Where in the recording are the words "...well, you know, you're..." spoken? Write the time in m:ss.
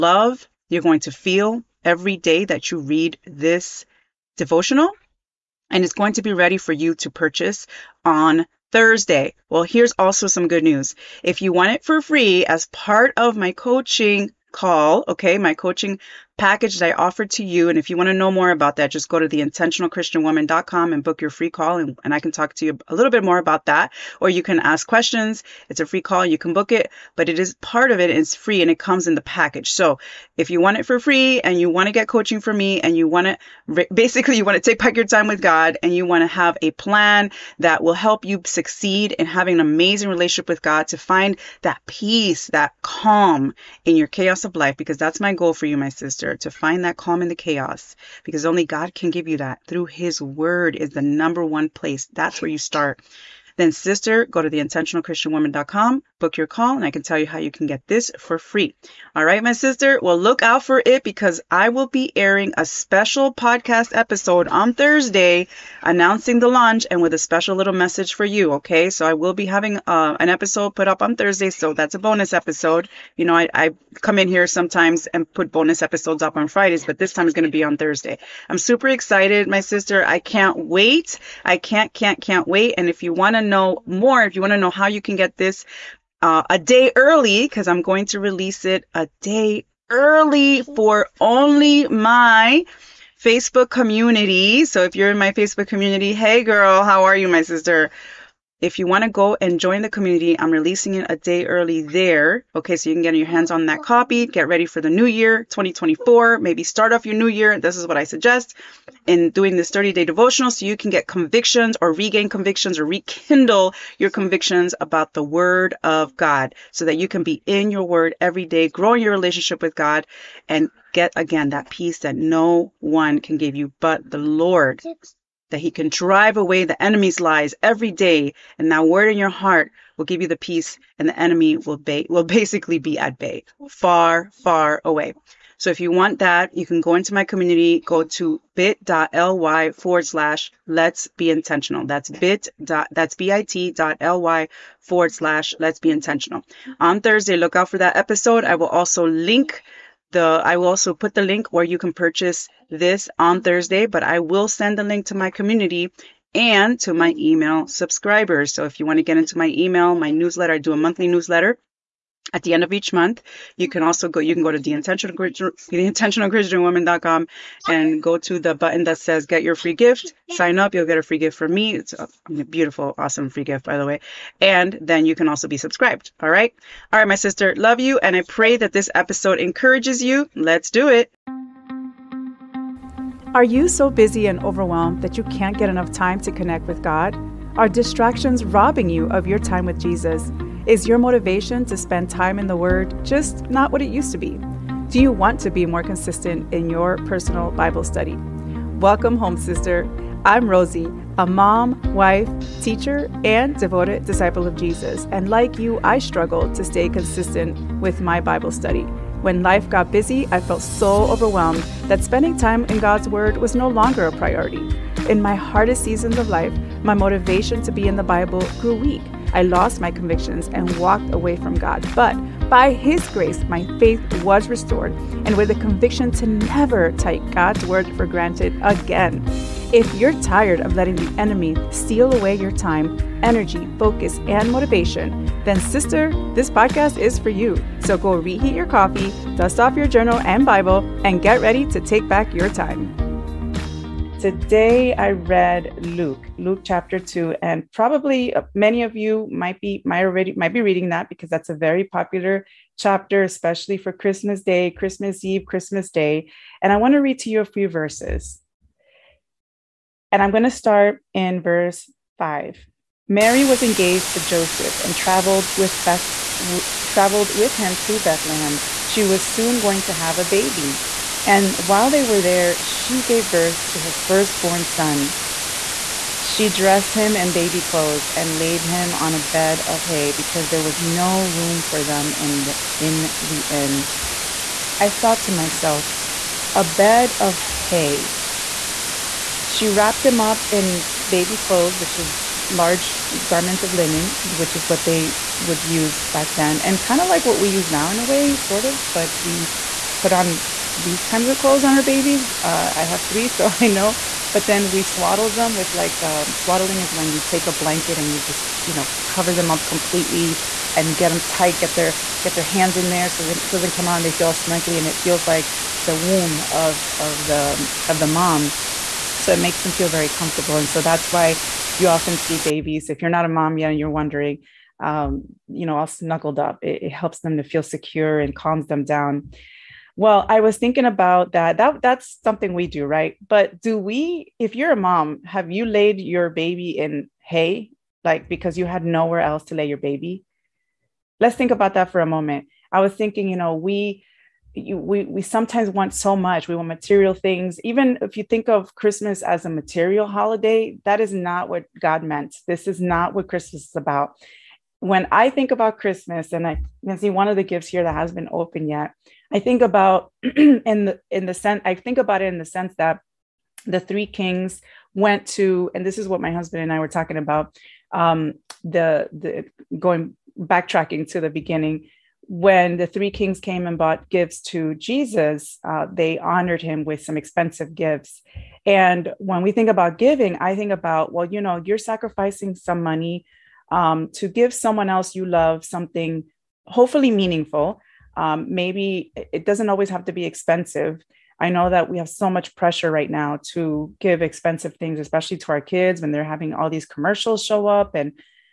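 6:21.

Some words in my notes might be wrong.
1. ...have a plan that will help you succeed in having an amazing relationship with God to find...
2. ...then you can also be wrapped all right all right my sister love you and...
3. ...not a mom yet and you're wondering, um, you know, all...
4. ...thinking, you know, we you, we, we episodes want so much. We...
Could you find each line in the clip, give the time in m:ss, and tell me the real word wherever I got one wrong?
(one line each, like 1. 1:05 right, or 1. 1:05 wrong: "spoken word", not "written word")
1. 0:36 right
2. 2:54 wrong: "subscribed", not "wrapped"
3. 5:23 right
4. 5:42 wrong: "sometimes", not "episodes".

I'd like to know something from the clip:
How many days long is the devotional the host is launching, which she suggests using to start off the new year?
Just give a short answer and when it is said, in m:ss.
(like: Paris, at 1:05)
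30, at 1:49.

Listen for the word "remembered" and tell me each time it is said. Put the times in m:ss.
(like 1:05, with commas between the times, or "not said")
not said.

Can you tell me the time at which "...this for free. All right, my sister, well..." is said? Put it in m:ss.
0:57.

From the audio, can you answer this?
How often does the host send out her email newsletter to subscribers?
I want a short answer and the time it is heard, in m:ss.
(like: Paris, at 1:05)
Monthly, at 2:40.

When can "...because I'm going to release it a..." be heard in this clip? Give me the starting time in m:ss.
1:27.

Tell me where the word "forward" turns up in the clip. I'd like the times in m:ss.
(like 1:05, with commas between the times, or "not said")
2:19, 2:24.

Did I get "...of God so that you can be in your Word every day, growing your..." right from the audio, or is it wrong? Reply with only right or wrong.
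right.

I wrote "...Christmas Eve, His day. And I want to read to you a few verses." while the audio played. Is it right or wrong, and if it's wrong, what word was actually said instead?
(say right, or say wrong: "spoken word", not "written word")
wrong: "Christmas", not "His".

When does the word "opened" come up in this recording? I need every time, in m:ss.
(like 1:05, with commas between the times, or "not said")
5:58.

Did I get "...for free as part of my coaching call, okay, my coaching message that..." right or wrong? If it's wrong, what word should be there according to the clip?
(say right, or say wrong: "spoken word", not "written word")
wrong: "package", not "message".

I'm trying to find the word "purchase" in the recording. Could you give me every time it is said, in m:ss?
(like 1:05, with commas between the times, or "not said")
0:07, 2:31.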